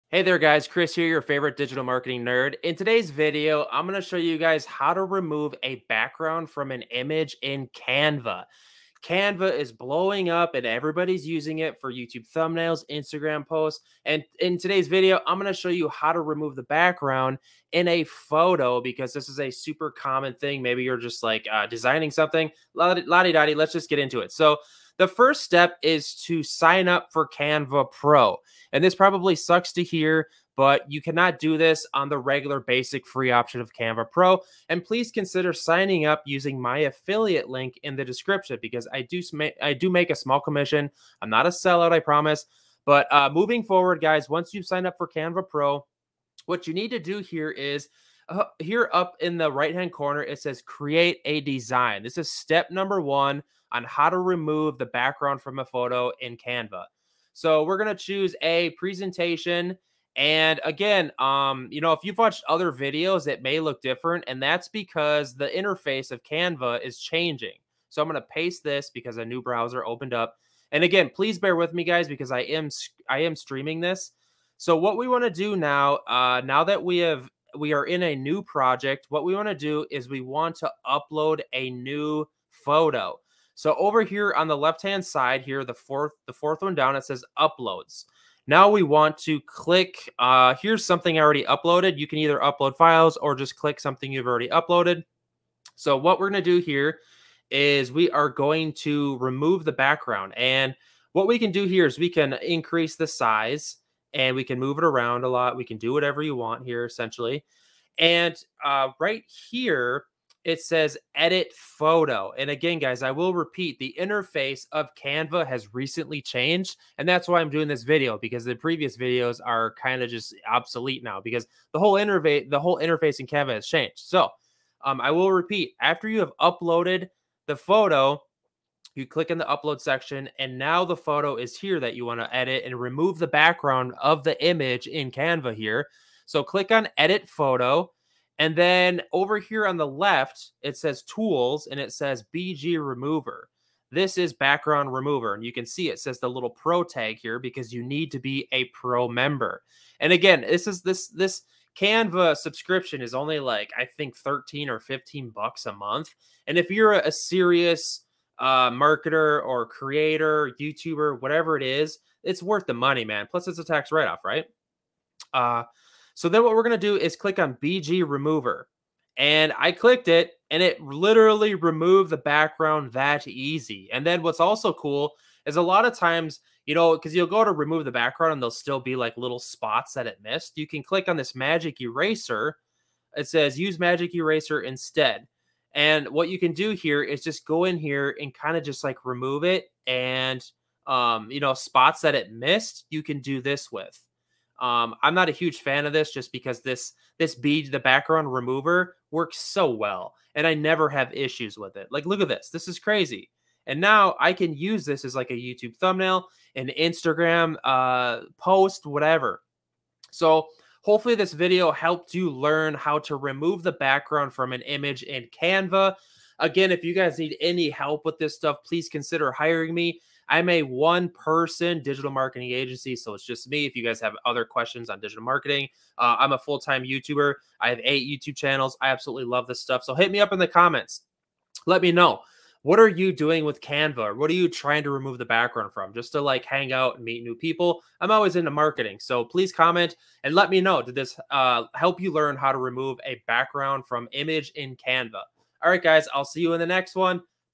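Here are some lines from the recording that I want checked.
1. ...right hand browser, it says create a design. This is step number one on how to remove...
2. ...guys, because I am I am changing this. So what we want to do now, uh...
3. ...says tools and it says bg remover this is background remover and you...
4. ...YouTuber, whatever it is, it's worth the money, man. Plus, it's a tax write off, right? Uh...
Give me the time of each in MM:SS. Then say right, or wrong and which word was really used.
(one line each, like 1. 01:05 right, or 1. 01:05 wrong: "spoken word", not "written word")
1. 00:49 wrong: "corner", not "browser"
2. 01:11 wrong: "streaming", not "changing"
3. 02:20 right
4. 02:40 right.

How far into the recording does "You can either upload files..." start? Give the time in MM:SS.
01:31.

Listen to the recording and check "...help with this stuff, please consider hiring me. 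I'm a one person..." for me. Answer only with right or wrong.
right.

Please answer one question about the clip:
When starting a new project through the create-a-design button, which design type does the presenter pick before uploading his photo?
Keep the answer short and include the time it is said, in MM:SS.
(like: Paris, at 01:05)
Presentation, at 00:58.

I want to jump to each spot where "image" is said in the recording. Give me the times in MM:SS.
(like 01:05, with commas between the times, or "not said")
00:06, 02:14, 03:34, 04:04.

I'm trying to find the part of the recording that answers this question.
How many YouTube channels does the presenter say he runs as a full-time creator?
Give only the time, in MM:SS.
03:47.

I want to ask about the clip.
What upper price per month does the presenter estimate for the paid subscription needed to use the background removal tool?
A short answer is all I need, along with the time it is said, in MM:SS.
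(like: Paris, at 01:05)
$15, at 02:34.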